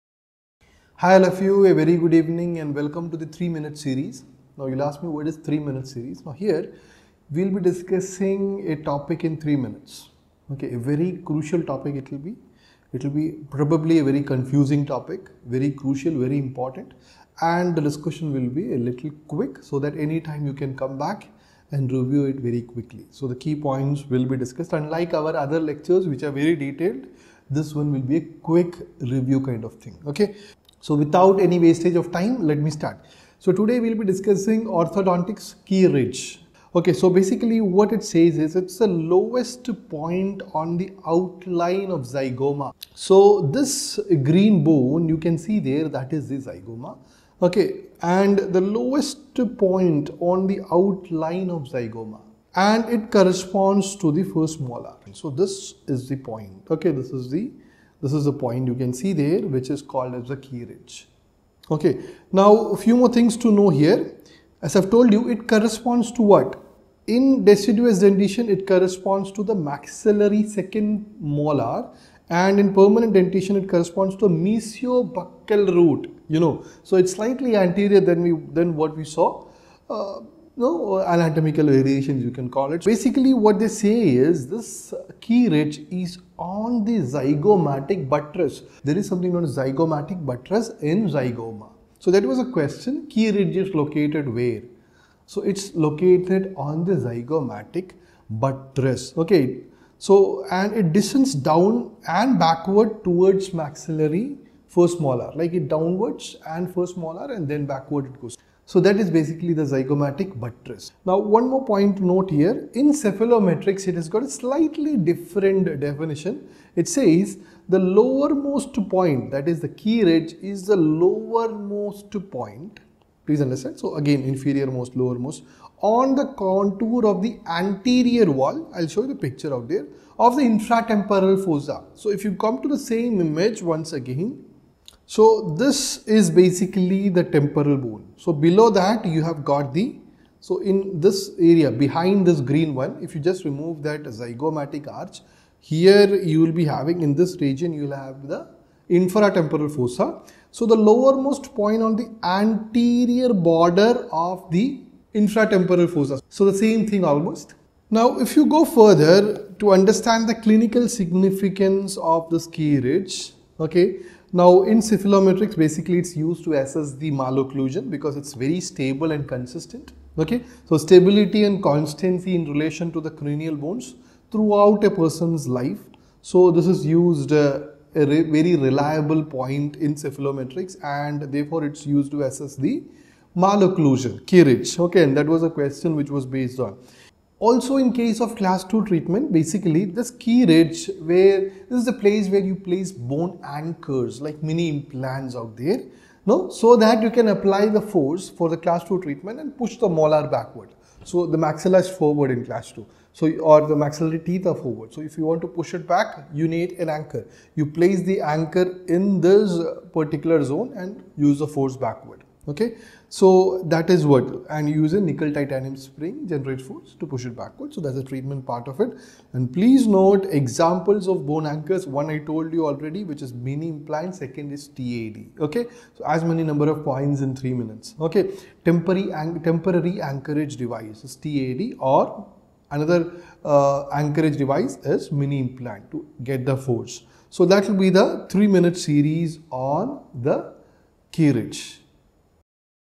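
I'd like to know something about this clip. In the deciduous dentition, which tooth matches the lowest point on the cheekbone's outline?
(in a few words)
Maxillary second molar.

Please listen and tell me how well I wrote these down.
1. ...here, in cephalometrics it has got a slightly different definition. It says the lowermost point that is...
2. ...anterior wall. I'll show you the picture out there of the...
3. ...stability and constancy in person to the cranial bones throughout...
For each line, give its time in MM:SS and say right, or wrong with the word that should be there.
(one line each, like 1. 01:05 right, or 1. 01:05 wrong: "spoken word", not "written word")
1. 01:52 right
2. 02:07 right
3. 02:50 wrong: "relation", not "person".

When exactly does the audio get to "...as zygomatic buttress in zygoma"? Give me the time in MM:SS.
01:29.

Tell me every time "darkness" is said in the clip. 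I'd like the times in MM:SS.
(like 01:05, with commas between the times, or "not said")
not said.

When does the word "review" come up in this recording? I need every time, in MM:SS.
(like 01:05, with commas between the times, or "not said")
00:21, 00:28.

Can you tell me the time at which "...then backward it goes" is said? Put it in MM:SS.
01:47.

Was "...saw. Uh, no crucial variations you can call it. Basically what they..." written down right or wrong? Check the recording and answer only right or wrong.
wrong.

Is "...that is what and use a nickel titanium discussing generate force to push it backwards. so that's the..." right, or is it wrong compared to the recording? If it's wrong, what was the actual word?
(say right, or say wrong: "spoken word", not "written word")
wrong: "spring", not "discussing".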